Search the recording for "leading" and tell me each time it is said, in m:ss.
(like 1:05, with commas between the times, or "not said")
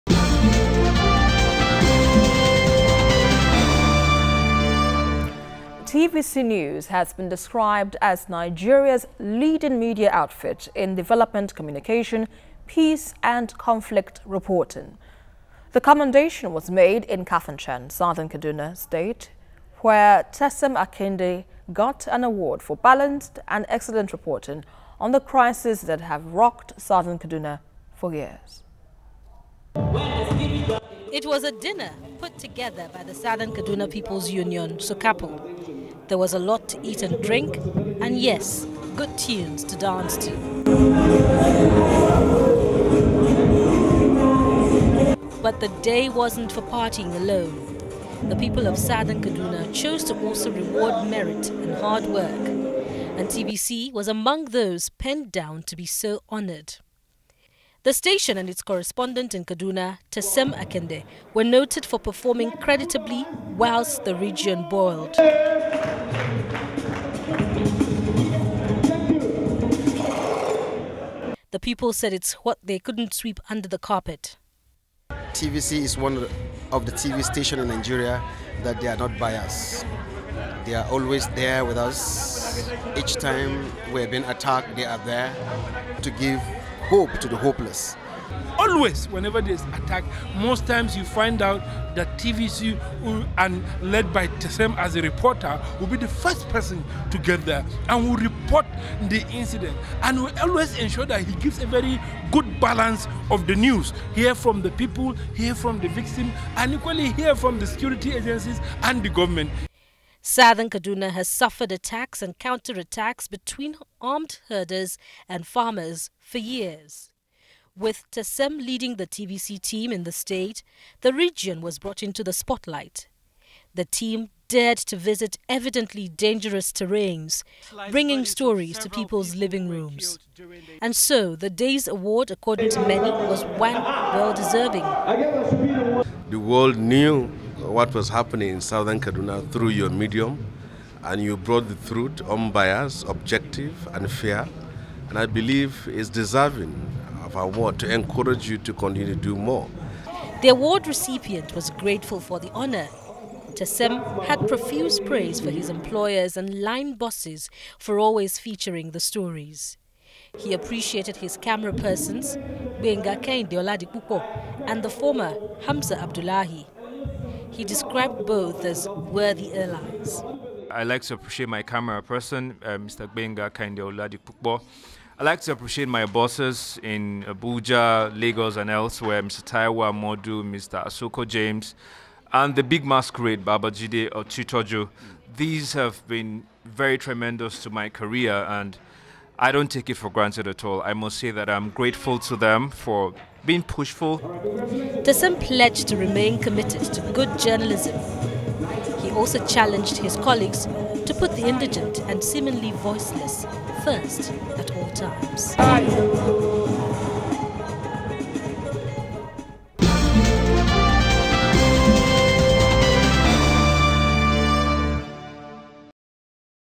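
0:09, 1:58.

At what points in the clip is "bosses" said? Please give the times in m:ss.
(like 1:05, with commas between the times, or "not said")
2:36, 2:56.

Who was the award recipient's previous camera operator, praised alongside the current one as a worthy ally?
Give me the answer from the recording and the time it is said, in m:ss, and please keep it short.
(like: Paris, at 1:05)
Hamza Abdullahi, at 2:45.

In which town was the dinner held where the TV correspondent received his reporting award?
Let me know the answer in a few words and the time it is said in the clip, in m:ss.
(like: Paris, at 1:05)
Kafanchan, at 0:17.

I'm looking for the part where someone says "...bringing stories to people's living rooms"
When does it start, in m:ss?
2:07.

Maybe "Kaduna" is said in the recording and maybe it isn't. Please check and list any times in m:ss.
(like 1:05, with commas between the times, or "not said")
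0:18, 0:27, 0:33, 0:49, 0:59, 1:50, 2:18.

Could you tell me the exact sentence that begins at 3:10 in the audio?
I must say that I'm grateful to them for being pushful.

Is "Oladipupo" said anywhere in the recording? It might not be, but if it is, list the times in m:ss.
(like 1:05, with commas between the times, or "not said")
2:43, 2:53.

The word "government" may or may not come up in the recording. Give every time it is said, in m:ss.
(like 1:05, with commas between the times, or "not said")
1:49.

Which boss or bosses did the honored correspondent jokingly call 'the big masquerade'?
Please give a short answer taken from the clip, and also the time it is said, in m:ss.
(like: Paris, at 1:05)
Baba or Ochitoju, at 3:03.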